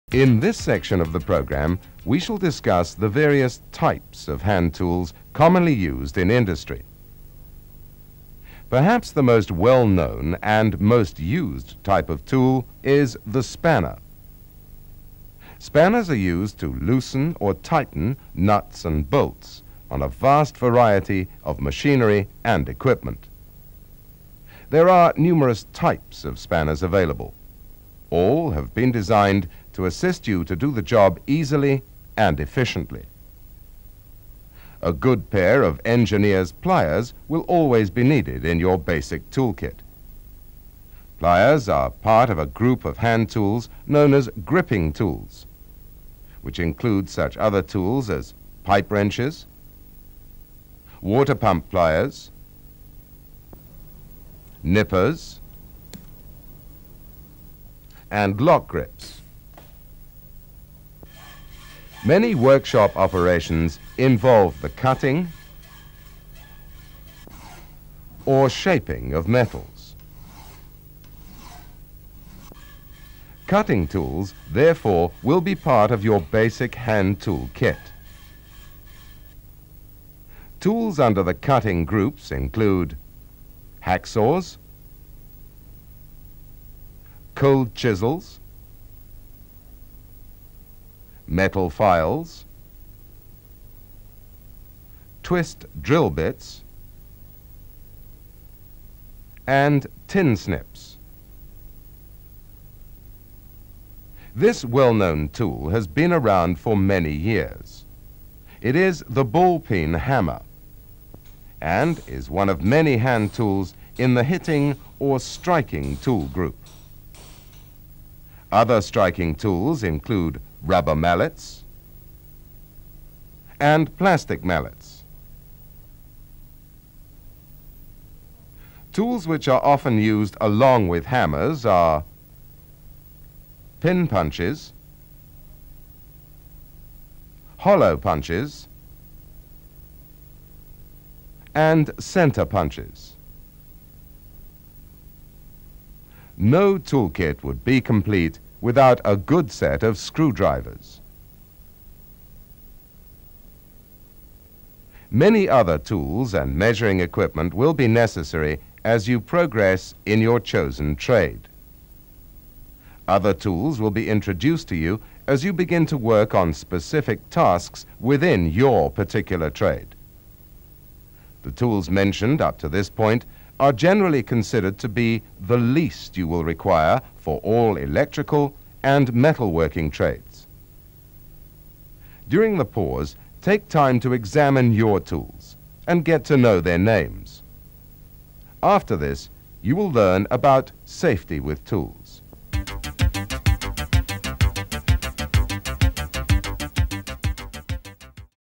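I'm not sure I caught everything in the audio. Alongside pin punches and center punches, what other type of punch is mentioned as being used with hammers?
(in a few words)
hollow punches.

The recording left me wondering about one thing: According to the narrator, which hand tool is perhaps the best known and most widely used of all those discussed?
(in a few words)
spanner.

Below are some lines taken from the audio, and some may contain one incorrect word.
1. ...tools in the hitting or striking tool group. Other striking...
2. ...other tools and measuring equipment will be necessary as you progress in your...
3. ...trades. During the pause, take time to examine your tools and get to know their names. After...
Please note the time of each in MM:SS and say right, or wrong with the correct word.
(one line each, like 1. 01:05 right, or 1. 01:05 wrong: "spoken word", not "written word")
1. 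01:53 right
2. 02:35 right
3. 02:59 right.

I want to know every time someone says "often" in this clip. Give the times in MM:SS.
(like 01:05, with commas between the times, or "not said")
02:09.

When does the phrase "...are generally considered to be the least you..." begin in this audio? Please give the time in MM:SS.
02:53.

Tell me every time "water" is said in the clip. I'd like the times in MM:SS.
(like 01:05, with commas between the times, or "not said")
00:51.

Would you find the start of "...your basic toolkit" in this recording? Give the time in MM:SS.
00:38.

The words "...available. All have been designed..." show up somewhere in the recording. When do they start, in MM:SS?
00:26.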